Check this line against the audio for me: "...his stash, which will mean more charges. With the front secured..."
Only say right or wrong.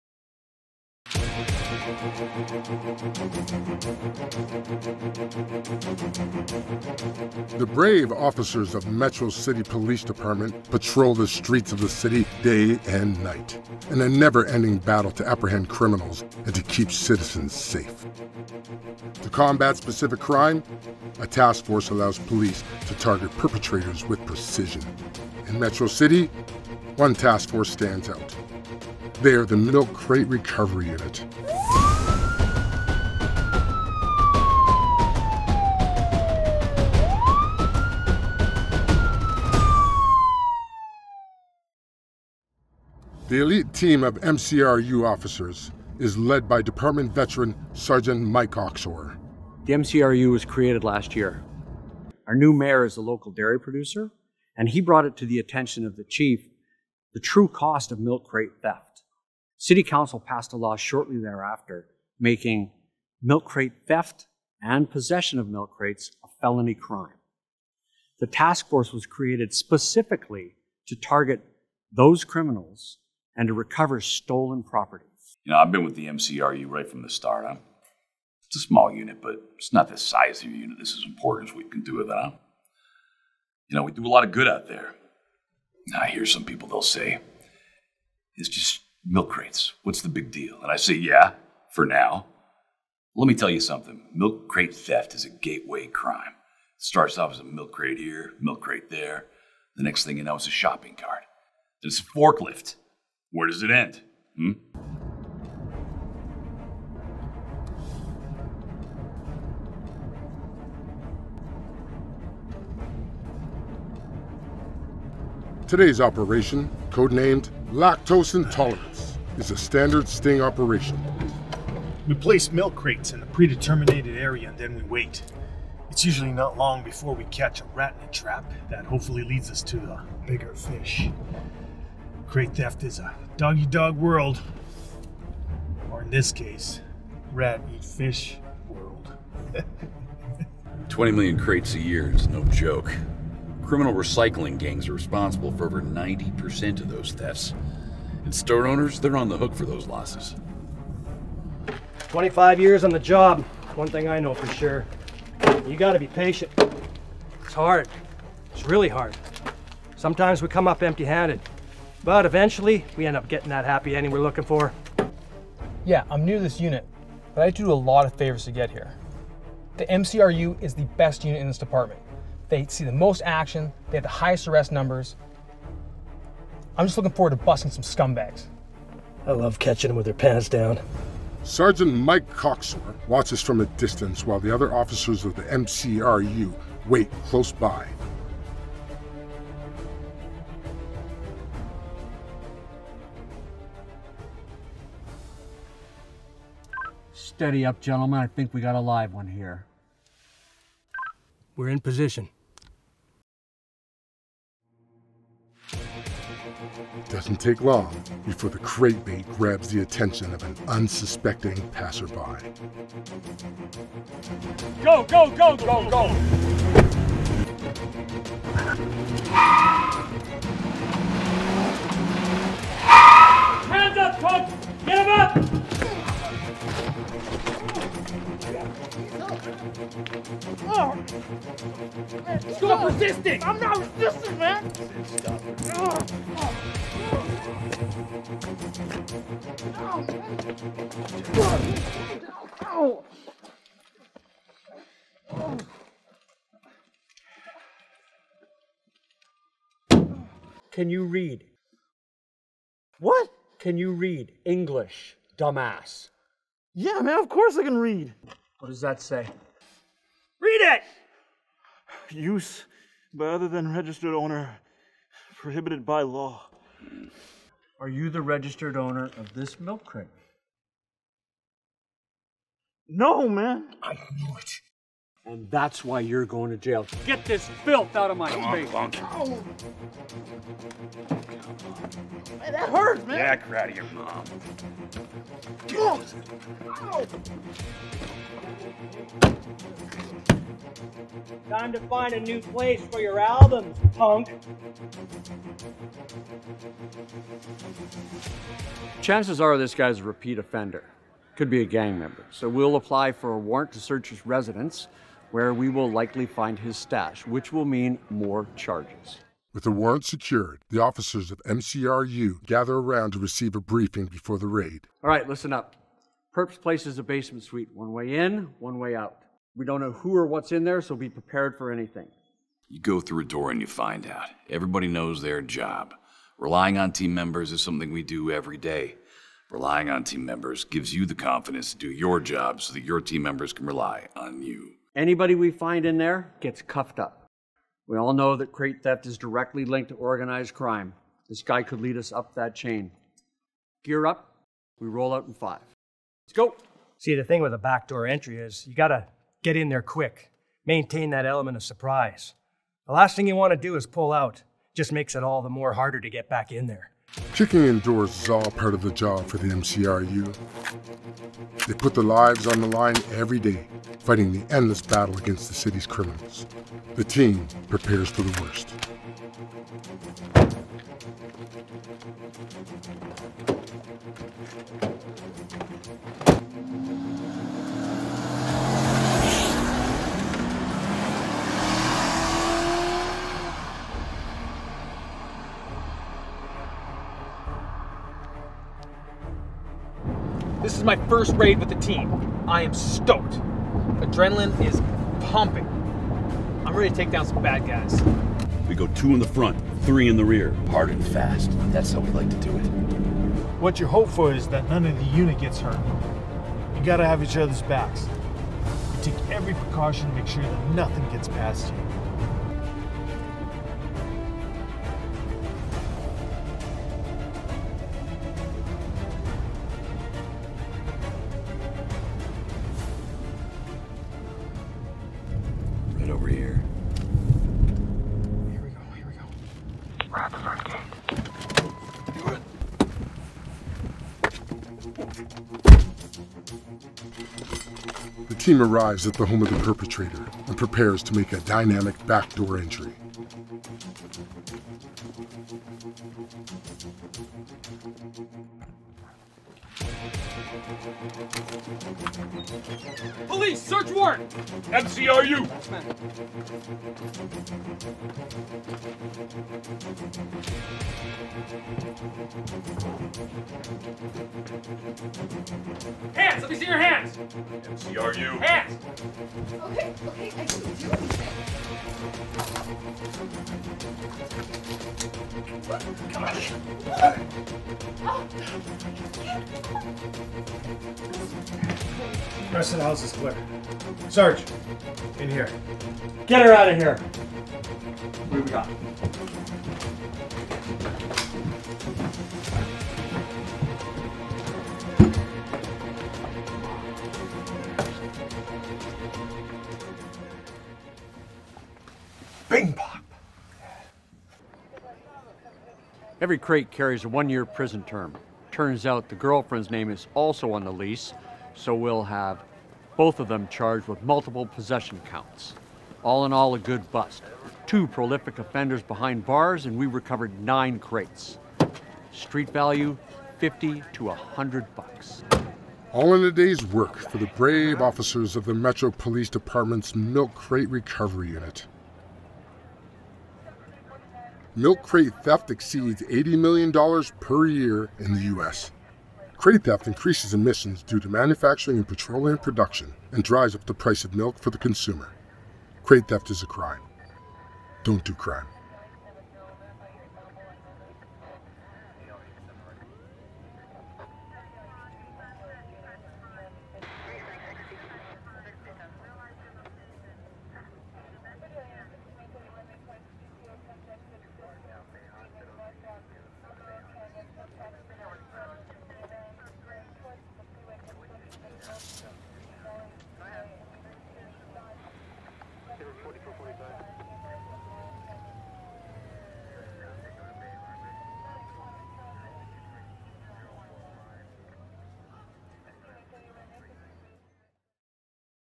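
wrong.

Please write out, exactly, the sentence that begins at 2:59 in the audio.
I love catching them with their pants down.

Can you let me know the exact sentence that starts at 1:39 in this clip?
The next thing you know, it's a shopping cart.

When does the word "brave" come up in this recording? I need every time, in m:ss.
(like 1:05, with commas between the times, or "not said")
0:07, 8:47.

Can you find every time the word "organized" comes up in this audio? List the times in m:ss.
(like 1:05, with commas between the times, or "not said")
5:39.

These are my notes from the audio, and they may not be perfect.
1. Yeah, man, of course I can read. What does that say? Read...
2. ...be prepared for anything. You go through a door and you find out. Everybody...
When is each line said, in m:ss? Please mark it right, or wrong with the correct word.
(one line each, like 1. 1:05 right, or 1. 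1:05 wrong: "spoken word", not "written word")
1. 4:16 right
2. 5:20 right.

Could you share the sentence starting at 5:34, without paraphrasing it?
Anybody we find in there gets cuffed up.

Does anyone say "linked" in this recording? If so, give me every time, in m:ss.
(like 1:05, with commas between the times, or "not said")
5:39.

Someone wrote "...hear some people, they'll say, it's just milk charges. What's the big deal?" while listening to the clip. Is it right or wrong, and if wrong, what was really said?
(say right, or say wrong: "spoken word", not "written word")
wrong: "crates", not "charges".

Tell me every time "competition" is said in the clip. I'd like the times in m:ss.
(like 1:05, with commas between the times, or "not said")
not said.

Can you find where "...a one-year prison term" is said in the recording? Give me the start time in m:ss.
8:27.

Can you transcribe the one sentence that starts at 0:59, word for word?
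City Council passed a law shortly thereafter making milk crate theft and possession of milk crates a felony crime.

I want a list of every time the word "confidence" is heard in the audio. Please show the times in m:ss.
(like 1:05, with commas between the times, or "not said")
5:31.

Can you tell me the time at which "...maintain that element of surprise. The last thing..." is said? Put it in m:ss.
5:50.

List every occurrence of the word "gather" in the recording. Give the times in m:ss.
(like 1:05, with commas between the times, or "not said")
5:12.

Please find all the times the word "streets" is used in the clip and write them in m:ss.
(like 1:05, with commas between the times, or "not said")
0:11, 8:42.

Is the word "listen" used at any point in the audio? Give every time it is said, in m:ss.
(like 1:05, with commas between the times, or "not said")
5:15.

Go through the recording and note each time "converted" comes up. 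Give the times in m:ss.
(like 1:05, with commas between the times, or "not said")
not said.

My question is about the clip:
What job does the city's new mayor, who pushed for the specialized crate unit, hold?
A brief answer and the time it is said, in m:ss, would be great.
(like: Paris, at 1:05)
dairy producer, at 0:53.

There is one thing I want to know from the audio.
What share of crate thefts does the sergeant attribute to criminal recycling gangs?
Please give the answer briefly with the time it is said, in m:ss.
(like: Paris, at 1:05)
over 90%, at 2:25.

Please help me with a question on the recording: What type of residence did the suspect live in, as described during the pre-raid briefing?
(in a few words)
basement suite.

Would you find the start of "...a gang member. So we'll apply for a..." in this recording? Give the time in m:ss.
5:01.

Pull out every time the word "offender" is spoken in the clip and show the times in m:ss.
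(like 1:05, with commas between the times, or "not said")
5:00, 8:38.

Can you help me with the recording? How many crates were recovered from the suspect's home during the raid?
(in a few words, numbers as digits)
9.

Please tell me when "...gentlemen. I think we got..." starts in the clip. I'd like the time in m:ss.
3:17.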